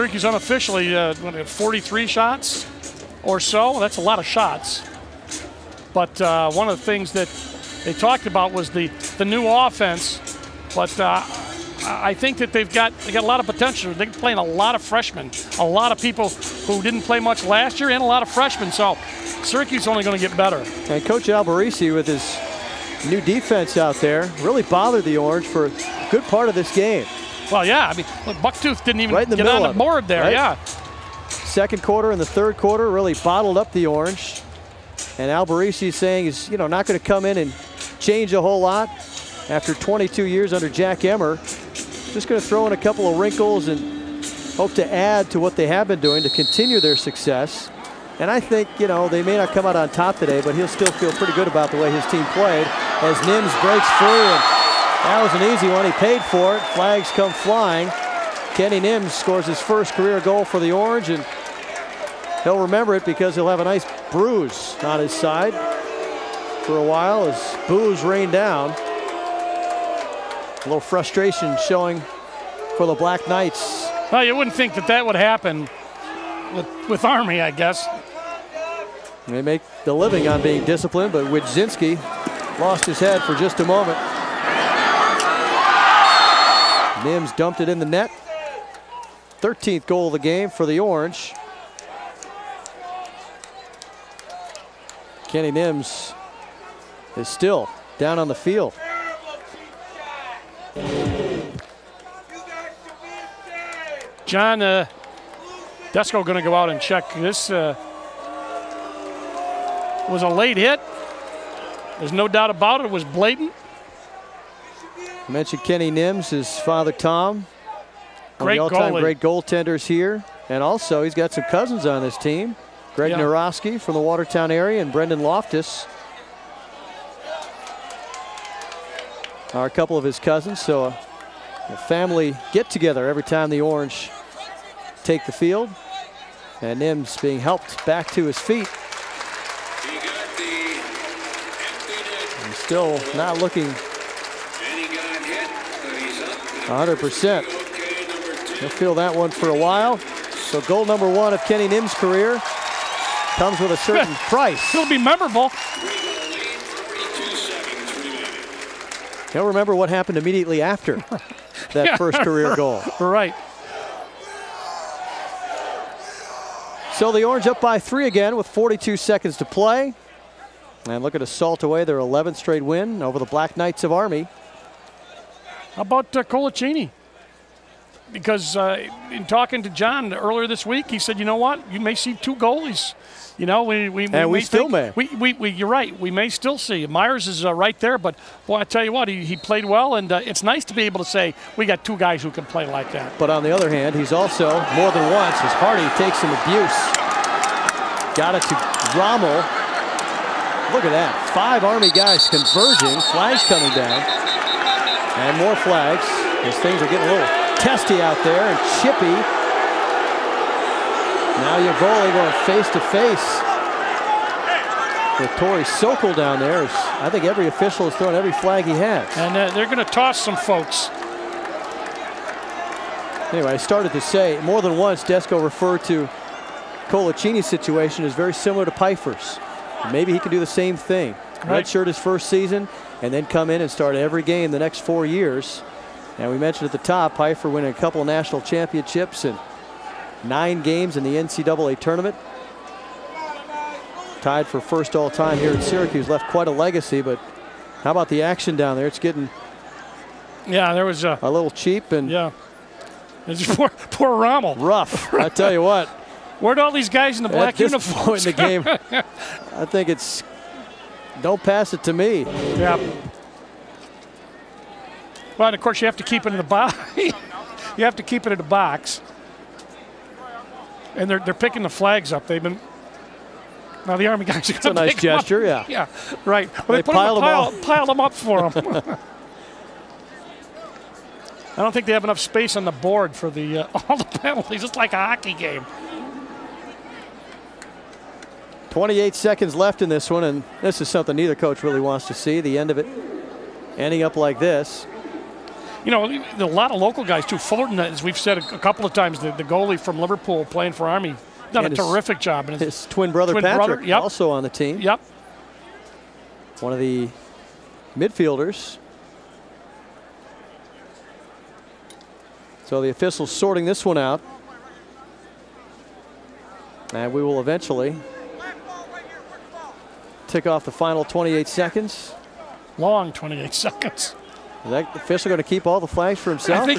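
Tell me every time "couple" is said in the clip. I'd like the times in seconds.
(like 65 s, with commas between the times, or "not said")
42 s, 129 s, 237 s, 298 s.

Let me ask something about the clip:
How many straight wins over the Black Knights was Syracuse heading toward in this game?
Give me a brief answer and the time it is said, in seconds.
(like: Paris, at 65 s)
11, at 171 s.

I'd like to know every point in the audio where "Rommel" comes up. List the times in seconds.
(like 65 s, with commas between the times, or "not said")
198 s, 254 s.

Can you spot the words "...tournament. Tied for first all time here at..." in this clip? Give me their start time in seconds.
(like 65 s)
241 s.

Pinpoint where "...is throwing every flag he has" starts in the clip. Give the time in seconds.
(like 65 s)
217 s.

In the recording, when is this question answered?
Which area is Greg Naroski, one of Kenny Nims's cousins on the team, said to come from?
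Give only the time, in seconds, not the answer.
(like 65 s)
124 s.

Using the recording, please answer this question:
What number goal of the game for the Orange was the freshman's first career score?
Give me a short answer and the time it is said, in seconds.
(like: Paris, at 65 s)
13th, at 89 s.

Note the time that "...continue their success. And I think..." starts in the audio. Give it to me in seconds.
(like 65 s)
46 s.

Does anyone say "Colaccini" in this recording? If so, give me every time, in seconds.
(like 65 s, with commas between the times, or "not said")
176 s, 226 s.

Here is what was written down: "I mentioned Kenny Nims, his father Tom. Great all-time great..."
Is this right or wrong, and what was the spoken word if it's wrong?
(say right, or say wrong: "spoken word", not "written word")
right.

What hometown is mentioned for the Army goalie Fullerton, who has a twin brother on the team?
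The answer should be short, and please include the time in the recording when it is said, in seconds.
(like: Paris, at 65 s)
Liverpool, at 299 s.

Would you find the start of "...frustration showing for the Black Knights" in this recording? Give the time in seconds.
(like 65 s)
70 s.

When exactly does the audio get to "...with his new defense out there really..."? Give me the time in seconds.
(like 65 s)
21 s.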